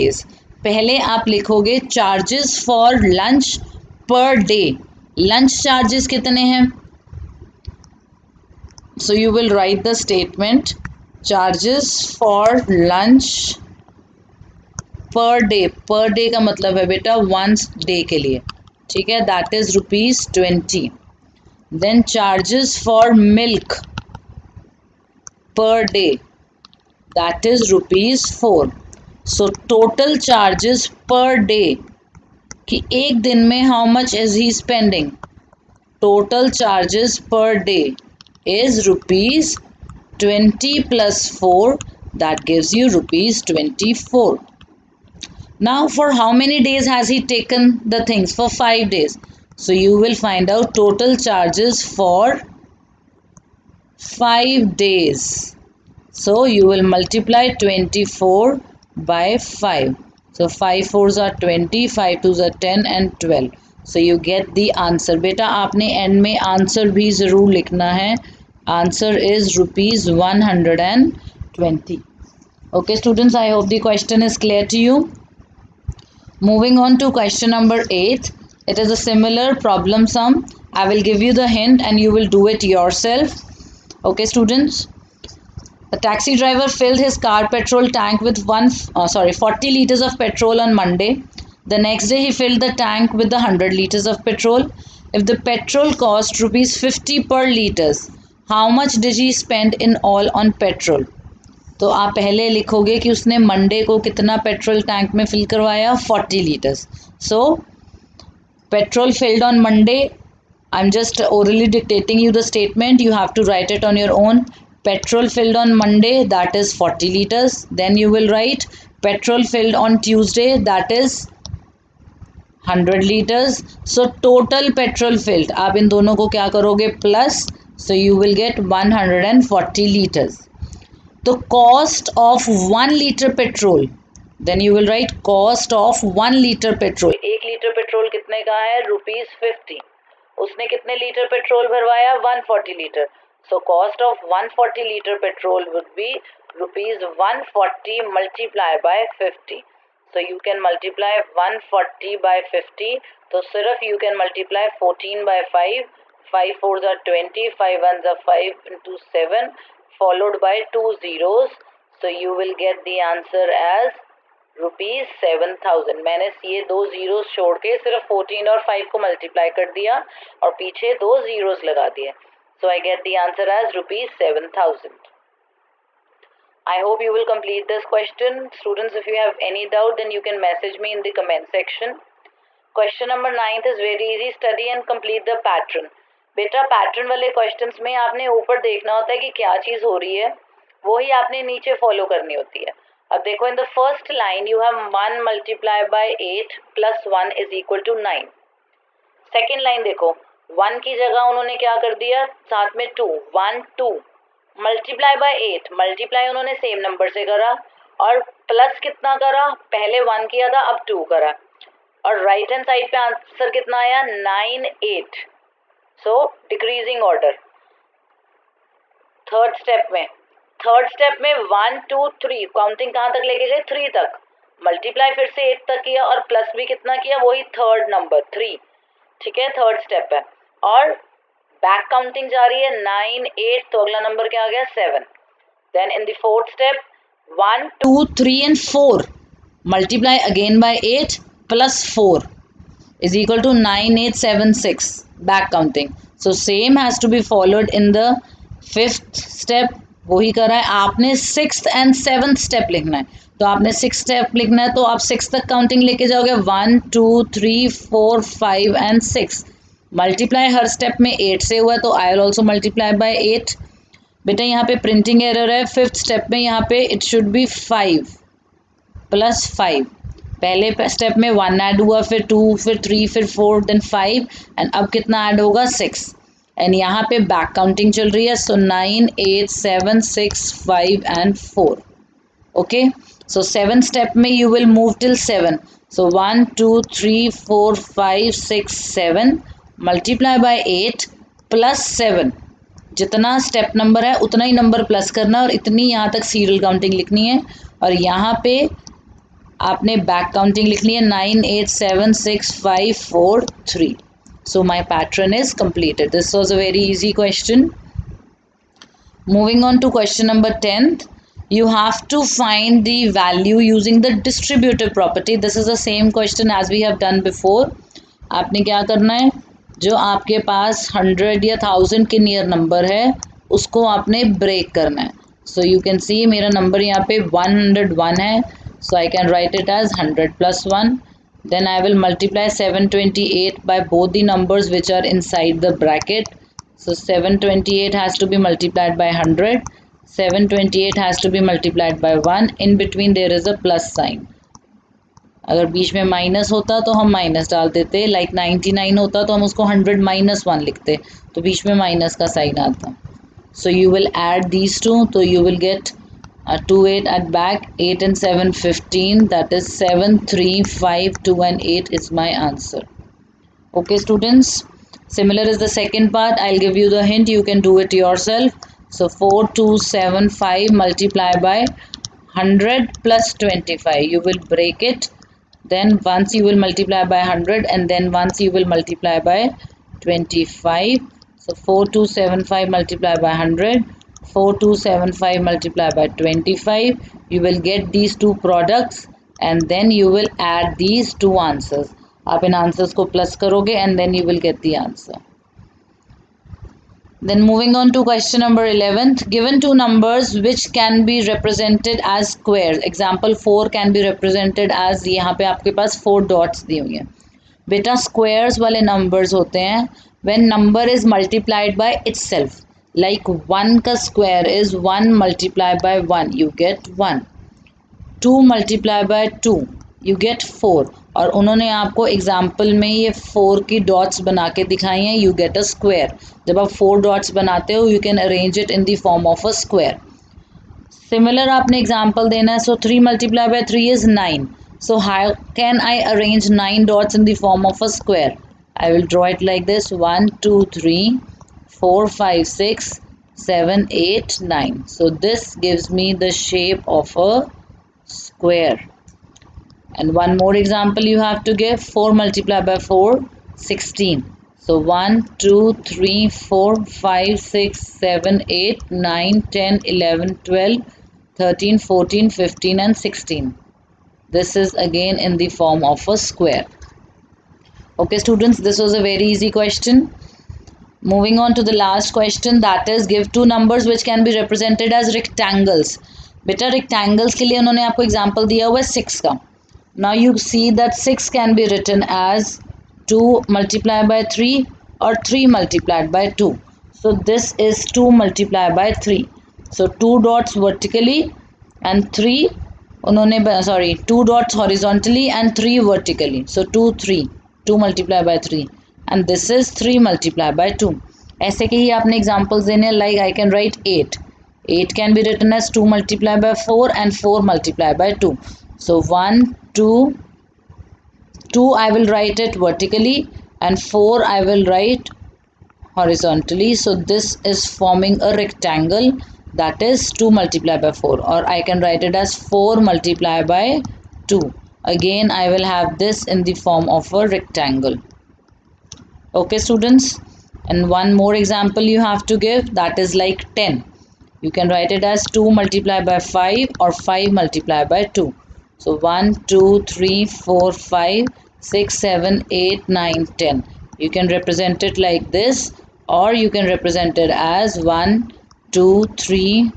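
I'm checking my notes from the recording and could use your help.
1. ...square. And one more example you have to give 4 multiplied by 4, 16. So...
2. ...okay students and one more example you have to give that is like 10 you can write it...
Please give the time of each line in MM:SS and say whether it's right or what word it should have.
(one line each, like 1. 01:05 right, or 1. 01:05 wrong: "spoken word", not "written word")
1. 07:28 right
2. 08:49 right.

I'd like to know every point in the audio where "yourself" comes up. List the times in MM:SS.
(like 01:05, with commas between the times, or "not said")
01:22, 06:08.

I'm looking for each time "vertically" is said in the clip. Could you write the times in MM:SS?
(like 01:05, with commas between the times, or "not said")
08:10, 08:15, 08:32.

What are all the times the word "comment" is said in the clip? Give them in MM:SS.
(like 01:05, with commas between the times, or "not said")
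03:01.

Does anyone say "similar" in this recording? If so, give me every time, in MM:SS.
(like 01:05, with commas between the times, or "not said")
01:18, 06:05.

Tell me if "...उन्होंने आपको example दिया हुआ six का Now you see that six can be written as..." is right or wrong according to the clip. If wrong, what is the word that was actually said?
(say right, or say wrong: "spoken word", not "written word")
right.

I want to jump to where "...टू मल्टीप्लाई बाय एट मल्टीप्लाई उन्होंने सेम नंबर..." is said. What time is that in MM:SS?
03:23.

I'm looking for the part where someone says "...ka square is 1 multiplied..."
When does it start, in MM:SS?
06:53.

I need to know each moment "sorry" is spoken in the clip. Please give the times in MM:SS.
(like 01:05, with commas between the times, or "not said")
01:29, 08:13.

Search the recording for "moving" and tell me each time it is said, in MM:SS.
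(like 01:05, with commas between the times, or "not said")
01:16, 07:51.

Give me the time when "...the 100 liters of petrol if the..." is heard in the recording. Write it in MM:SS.
01:33.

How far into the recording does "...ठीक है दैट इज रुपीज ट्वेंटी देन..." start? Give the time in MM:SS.
00:18.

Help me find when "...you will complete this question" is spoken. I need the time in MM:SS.
02:57.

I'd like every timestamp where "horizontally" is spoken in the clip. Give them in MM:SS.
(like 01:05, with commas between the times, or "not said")
08:14, 08:35.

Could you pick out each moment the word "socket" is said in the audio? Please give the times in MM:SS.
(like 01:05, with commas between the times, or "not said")
not said.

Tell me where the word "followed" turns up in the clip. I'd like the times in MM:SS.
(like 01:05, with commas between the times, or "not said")
02:39, 04:07.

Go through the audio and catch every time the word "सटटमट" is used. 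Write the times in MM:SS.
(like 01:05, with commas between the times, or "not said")
00:10, 01:52.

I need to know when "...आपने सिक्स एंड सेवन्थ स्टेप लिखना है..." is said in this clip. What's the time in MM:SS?
04:10.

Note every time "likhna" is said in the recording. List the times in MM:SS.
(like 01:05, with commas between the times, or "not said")
01:07.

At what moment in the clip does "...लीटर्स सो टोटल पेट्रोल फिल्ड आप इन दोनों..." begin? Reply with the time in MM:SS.
02:03.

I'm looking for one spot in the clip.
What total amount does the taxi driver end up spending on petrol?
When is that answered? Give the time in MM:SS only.
02:44.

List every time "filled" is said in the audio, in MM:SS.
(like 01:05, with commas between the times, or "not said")
01:26, 01:32.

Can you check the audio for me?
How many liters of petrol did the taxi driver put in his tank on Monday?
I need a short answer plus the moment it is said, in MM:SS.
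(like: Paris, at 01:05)
40 liters, at 01:29.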